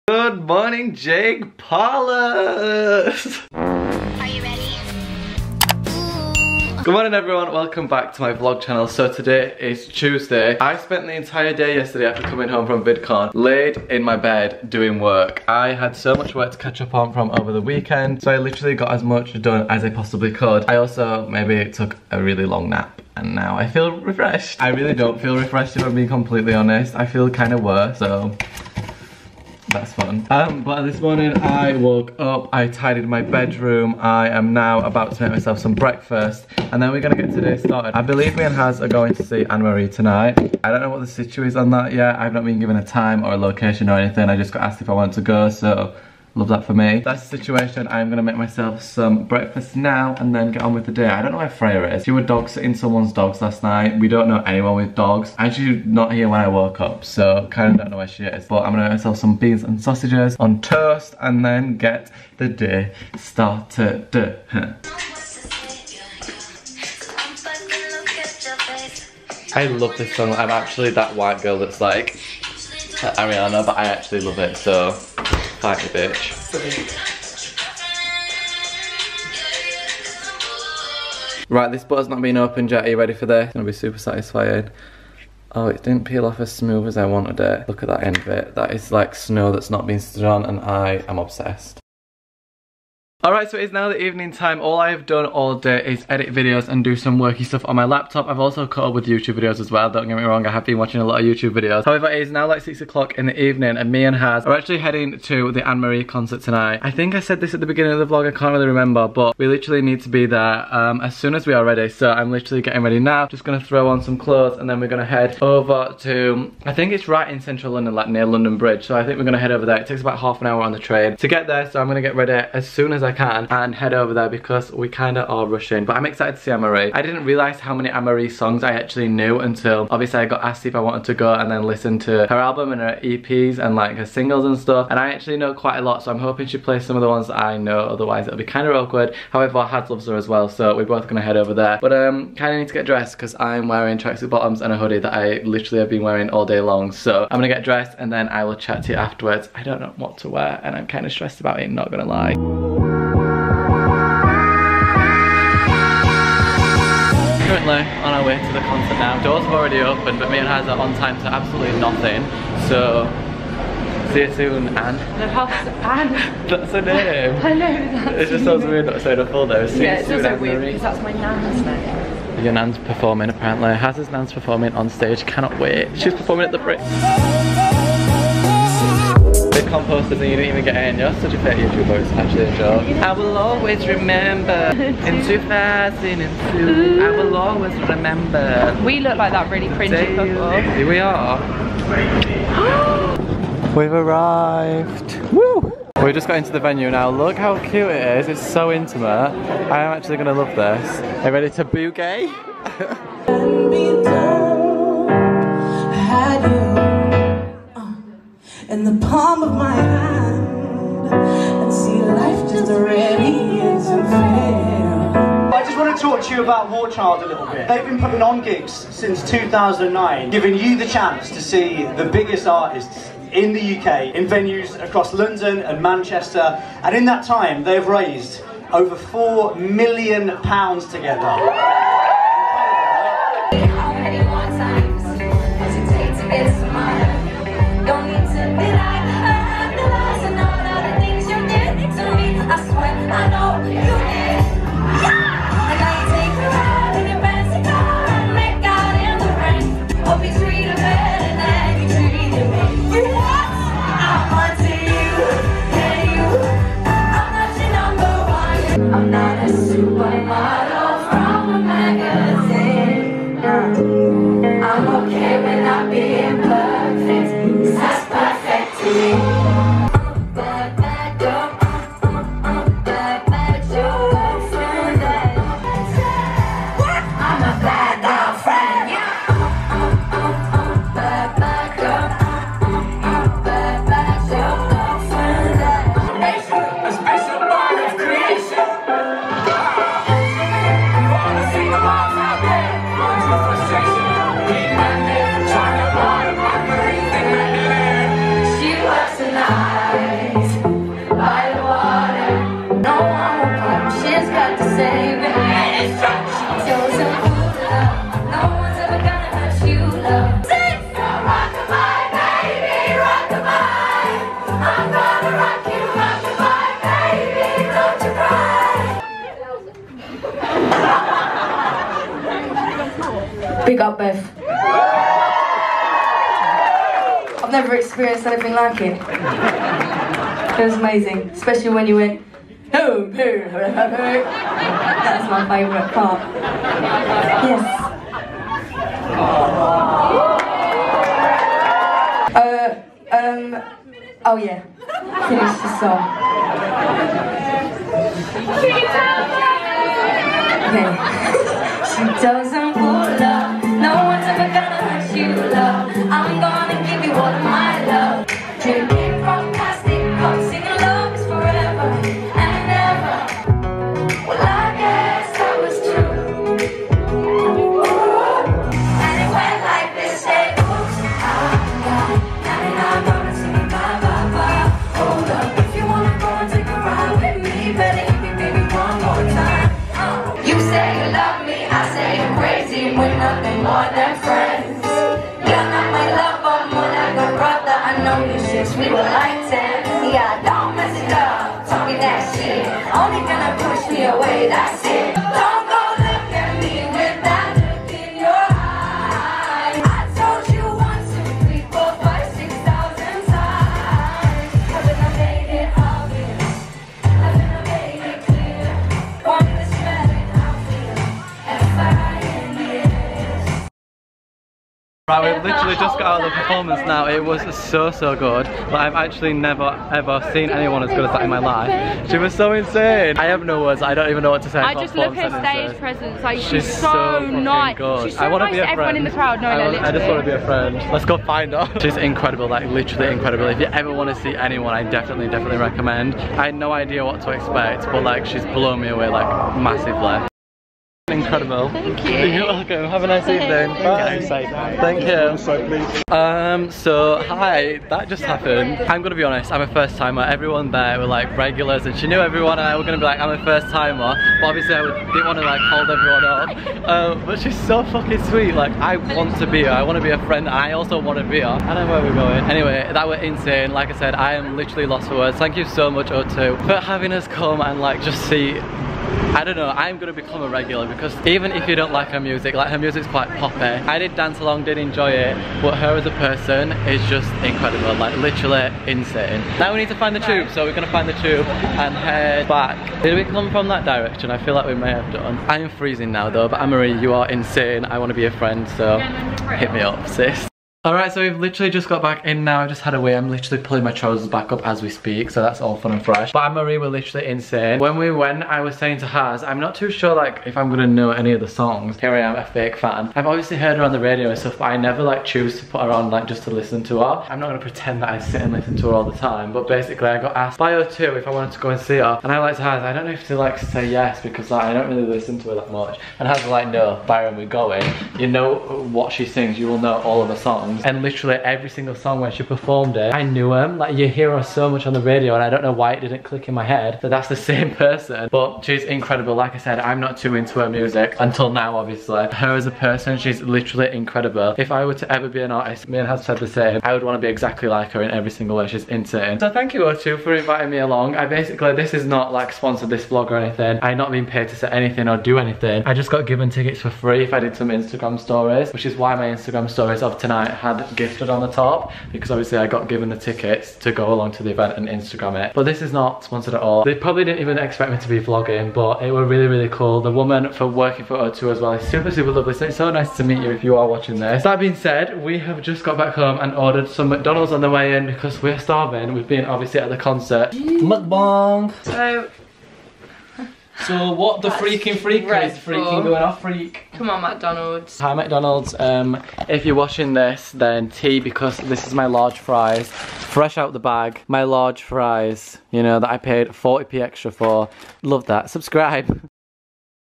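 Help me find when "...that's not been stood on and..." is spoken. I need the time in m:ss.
1:29.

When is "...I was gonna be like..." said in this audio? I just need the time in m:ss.
7:32.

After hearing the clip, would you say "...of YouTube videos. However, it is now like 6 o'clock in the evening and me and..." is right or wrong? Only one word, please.
right.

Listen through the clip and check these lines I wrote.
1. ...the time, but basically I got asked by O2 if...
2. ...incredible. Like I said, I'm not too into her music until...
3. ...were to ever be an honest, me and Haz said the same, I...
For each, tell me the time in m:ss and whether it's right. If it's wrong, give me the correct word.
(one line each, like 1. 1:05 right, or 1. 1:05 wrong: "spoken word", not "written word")
1. 8:29 right
2. 8:48 right
3. 8:54 wrong: "artist", not "honest".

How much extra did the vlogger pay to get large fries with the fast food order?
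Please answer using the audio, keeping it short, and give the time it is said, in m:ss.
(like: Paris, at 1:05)
40p, at 9:46.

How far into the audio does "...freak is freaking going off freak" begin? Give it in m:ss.
9:34.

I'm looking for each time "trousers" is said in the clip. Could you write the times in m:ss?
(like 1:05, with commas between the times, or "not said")
8:13.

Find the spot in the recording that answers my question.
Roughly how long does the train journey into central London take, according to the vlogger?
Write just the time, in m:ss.
2:00.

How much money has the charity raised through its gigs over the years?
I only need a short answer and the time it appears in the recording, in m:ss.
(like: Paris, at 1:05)
£4 million, at 3:48.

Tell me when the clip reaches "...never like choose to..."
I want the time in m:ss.
8:24.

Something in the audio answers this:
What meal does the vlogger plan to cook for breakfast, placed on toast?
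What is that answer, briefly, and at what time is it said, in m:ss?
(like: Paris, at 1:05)
Beans and sausages, at 0:59.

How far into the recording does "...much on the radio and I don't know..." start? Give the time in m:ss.
8:44.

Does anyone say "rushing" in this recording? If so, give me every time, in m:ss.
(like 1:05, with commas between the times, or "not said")
2:05.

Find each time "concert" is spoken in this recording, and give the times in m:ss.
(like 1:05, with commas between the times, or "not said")
1:46, 2:38, 9:29.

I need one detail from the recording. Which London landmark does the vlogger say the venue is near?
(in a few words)
London Bridge.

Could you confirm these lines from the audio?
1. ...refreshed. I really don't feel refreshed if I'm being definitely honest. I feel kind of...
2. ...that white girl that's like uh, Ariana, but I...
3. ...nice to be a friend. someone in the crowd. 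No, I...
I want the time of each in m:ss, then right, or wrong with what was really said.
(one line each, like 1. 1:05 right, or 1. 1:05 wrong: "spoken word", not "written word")
1. 0:24 wrong: "completely", not "definitely"
2. 1:10 right
3. 7:08 wrong: "everyone", not "someone".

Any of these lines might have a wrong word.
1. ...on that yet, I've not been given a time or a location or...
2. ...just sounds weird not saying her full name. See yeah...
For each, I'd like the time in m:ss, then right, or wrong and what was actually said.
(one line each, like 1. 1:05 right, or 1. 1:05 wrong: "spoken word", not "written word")
1. 0:41 right
2. 2:48 right.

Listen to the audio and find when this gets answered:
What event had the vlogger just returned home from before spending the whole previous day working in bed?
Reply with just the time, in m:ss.
0:12.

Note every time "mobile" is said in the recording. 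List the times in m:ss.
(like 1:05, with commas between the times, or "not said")
not said.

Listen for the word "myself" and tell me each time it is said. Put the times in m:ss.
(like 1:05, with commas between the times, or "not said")
0:35, 0:48, 0:58.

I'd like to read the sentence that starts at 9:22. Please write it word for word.
So it's so nice to meet you if you are watching this.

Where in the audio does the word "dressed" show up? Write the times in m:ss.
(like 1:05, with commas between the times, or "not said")
2:22, 2:27.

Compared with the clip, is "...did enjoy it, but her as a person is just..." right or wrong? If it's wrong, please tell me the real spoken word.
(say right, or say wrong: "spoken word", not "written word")
right.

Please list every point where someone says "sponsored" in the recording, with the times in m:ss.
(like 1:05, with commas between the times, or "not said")
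9:02, 9:16.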